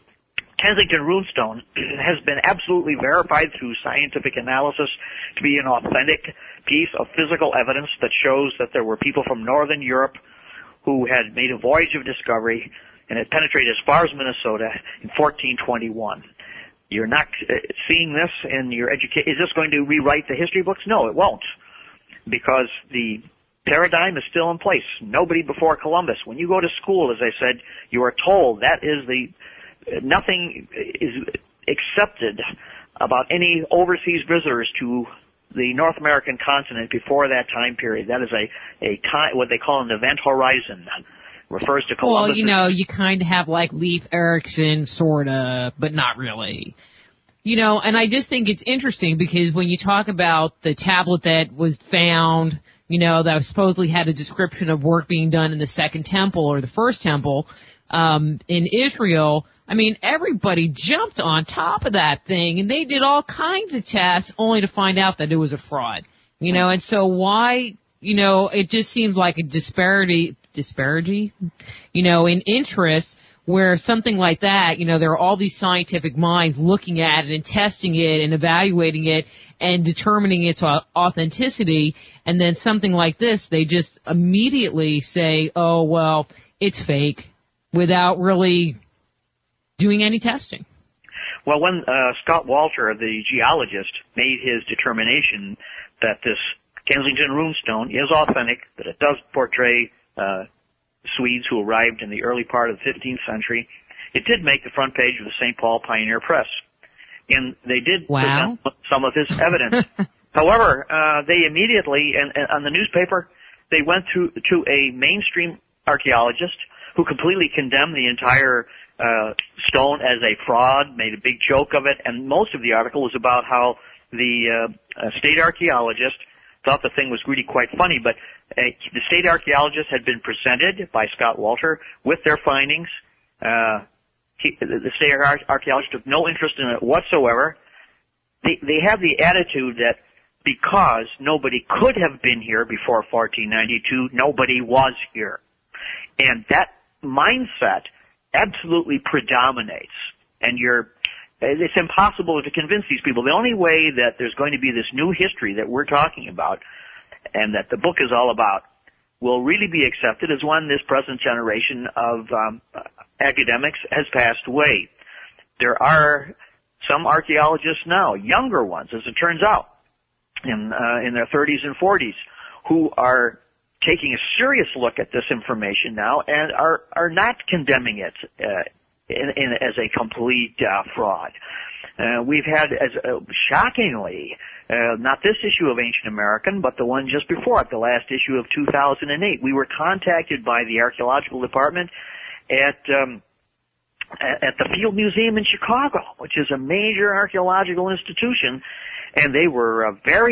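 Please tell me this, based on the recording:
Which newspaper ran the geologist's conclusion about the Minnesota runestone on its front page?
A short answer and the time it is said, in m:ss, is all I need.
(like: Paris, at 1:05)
St. Paul Pioneer Press, at 1:45.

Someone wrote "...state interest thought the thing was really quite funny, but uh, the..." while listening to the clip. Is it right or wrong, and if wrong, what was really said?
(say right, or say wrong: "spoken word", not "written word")
wrong: "archaeologist", not "interest".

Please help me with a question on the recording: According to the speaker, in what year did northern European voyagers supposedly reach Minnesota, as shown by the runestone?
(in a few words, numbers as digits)
1421.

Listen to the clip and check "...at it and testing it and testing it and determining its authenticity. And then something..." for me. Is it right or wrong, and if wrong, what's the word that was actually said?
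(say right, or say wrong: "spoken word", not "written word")
wrong: "evaluating", not "testing".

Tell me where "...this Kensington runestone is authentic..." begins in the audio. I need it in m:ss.
1:36.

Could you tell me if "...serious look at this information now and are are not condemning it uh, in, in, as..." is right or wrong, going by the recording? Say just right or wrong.
right.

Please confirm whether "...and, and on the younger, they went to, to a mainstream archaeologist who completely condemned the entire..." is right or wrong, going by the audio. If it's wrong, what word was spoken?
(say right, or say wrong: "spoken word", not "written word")
wrong: "newspaper", not "younger".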